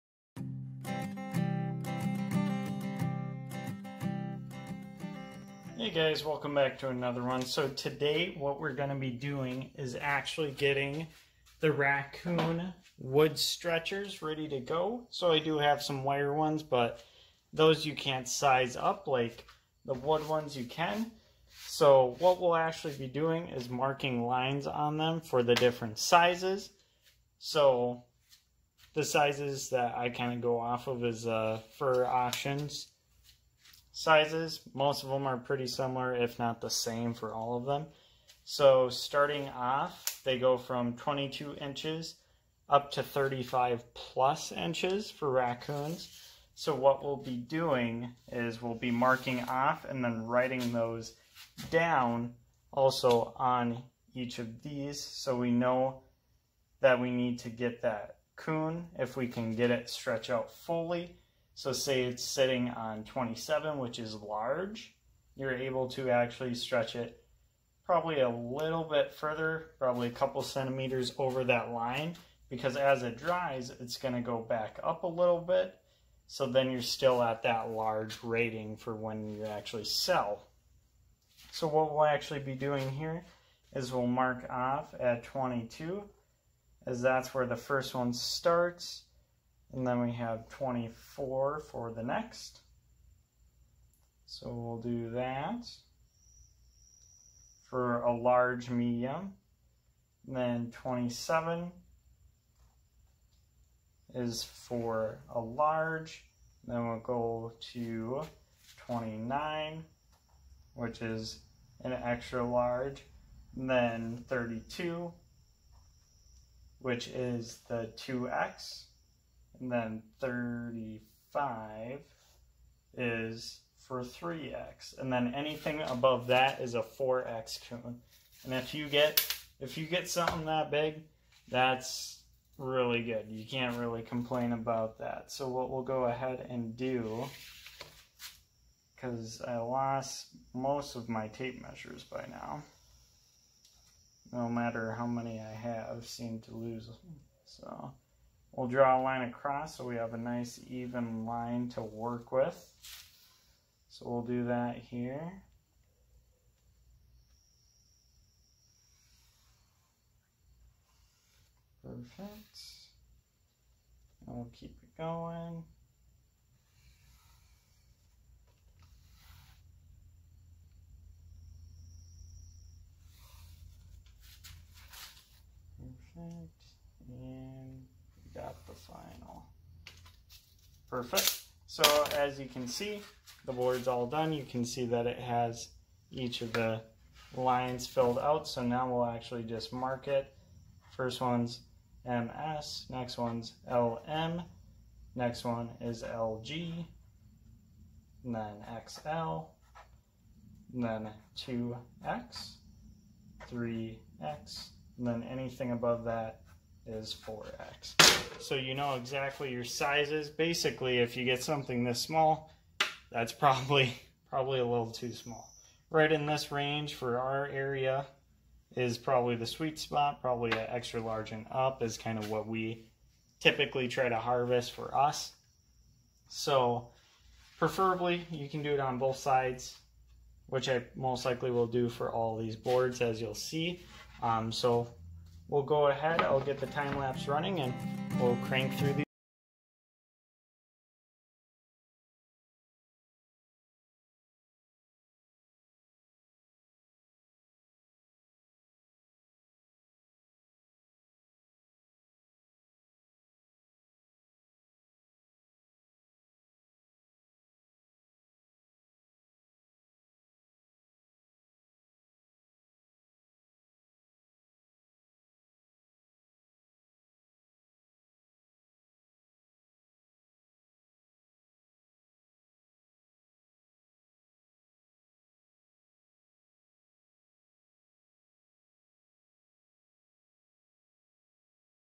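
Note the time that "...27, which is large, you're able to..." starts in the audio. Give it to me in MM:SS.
01:03.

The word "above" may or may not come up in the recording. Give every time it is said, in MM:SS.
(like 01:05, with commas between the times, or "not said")
02:05, 03:25.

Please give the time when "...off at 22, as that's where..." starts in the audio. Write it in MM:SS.
01:24.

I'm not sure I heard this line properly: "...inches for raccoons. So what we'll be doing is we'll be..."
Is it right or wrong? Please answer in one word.
right.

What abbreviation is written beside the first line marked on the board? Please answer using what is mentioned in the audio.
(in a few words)
MS.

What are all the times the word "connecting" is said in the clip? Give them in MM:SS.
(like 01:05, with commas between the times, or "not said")
not said.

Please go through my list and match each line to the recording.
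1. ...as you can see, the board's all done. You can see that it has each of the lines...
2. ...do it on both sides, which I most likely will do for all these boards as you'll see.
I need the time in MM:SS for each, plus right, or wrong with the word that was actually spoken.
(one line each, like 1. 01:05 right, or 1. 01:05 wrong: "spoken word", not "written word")
1. 03:02 right
2. 03:48 right.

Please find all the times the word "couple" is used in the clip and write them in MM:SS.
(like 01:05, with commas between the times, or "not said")
01:10.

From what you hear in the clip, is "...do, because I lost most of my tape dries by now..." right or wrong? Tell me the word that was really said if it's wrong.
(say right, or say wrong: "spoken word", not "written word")
wrong: "measures", not "dries".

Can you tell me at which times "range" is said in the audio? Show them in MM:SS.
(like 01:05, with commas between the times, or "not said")
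03:36.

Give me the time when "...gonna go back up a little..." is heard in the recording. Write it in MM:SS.
01:13.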